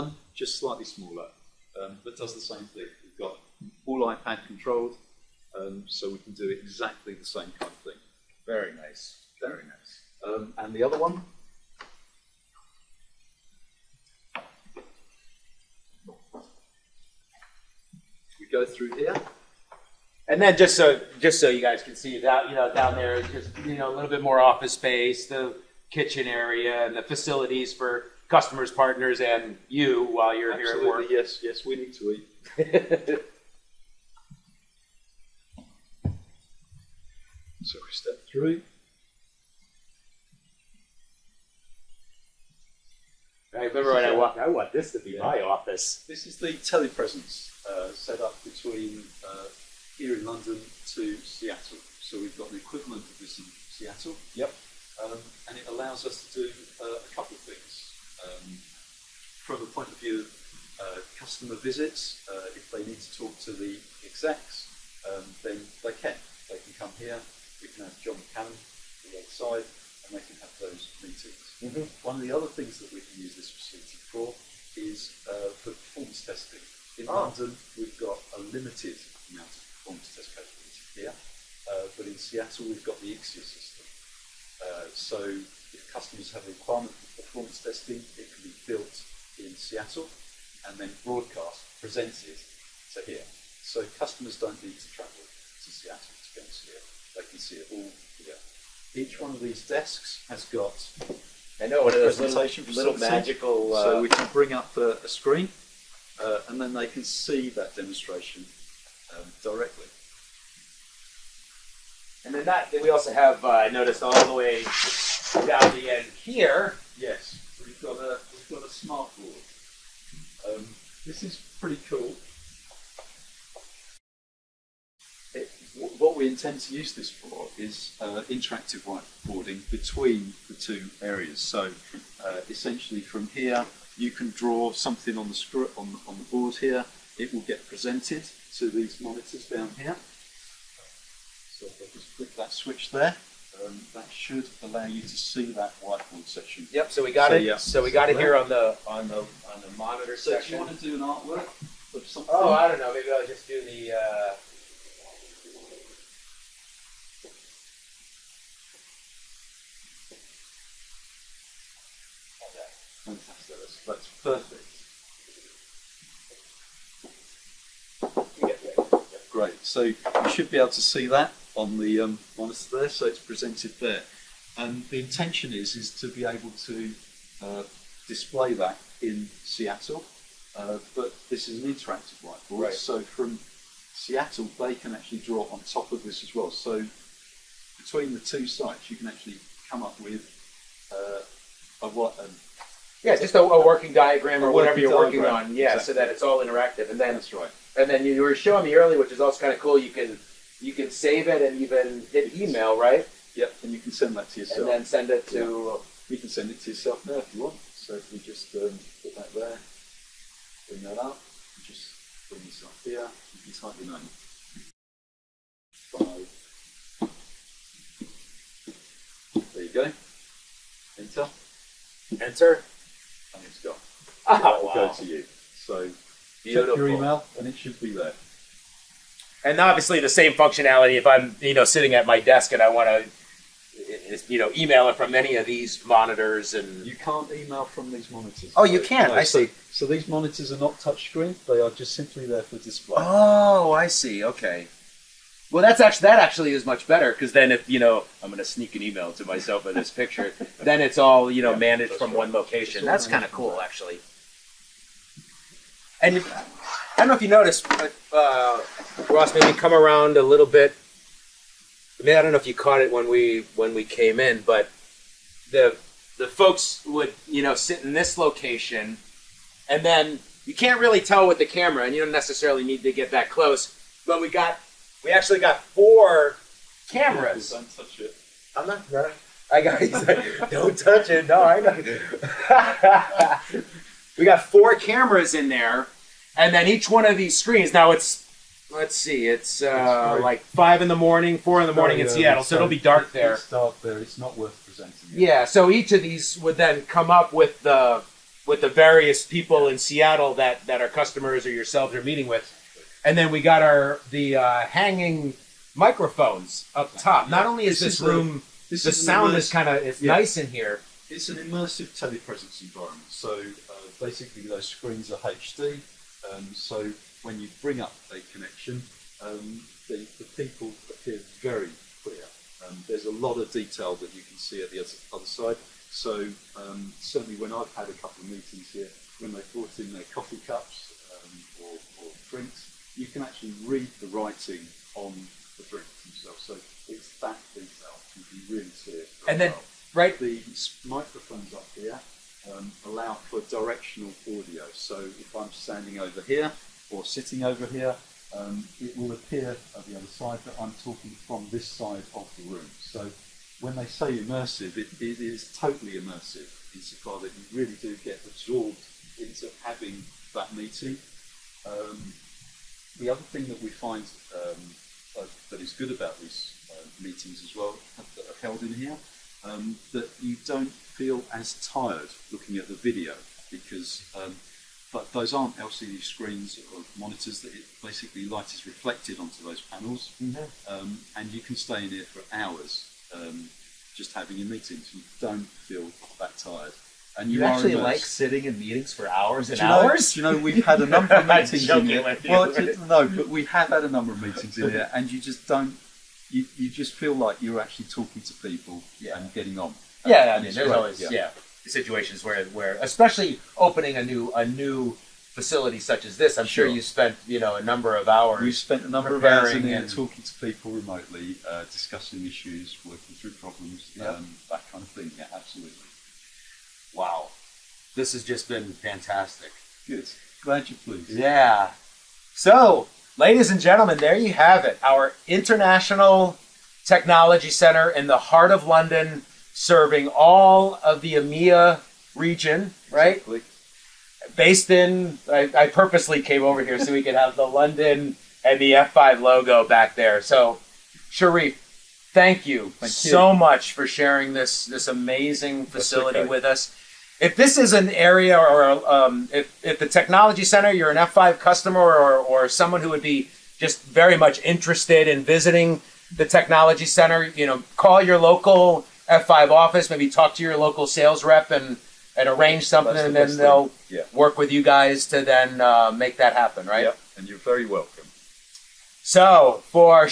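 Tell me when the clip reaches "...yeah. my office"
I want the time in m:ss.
0:45.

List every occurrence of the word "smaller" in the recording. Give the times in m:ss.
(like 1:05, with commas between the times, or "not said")
0:00.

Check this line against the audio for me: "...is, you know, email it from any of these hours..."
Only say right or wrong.
wrong.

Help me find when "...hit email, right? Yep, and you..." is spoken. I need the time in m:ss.
3:22.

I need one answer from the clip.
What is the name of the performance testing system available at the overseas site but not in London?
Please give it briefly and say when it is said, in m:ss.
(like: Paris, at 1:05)
Ixia, at 1:23.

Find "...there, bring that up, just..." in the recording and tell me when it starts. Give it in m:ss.
3:29.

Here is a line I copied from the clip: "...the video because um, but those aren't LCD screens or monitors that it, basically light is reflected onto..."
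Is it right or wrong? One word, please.
right.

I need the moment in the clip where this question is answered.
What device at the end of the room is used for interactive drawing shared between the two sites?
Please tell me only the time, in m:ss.
1:58.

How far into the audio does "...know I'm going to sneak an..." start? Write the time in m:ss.
4:07.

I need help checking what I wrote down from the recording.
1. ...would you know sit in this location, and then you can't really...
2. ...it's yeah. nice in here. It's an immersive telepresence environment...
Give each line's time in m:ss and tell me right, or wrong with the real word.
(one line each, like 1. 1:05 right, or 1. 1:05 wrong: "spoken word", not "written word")
1. 4:26 right
2. 5:09 right.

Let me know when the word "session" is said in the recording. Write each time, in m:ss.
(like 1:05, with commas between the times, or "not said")
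not said.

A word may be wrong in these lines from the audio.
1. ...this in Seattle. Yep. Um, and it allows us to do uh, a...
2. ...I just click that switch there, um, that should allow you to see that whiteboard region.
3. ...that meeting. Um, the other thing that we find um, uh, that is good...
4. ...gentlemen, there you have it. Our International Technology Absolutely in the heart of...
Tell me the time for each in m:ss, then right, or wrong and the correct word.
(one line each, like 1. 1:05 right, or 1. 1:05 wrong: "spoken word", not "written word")
1. 0:53 right
2. 2:21 wrong: "section", not "region"
3. 6:00 right
4. 7:03 wrong: "Center", not "Absolutely".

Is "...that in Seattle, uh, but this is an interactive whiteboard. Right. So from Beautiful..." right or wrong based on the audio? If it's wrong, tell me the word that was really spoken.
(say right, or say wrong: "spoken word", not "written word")
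wrong: "Seattle", not "Beautiful".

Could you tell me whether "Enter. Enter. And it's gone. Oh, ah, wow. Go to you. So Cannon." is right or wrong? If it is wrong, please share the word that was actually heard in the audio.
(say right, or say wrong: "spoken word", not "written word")
wrong: "Beautiful", not "Cannon".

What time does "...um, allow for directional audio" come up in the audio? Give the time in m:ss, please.
5:42.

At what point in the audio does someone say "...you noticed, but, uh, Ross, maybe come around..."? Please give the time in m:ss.
4:17.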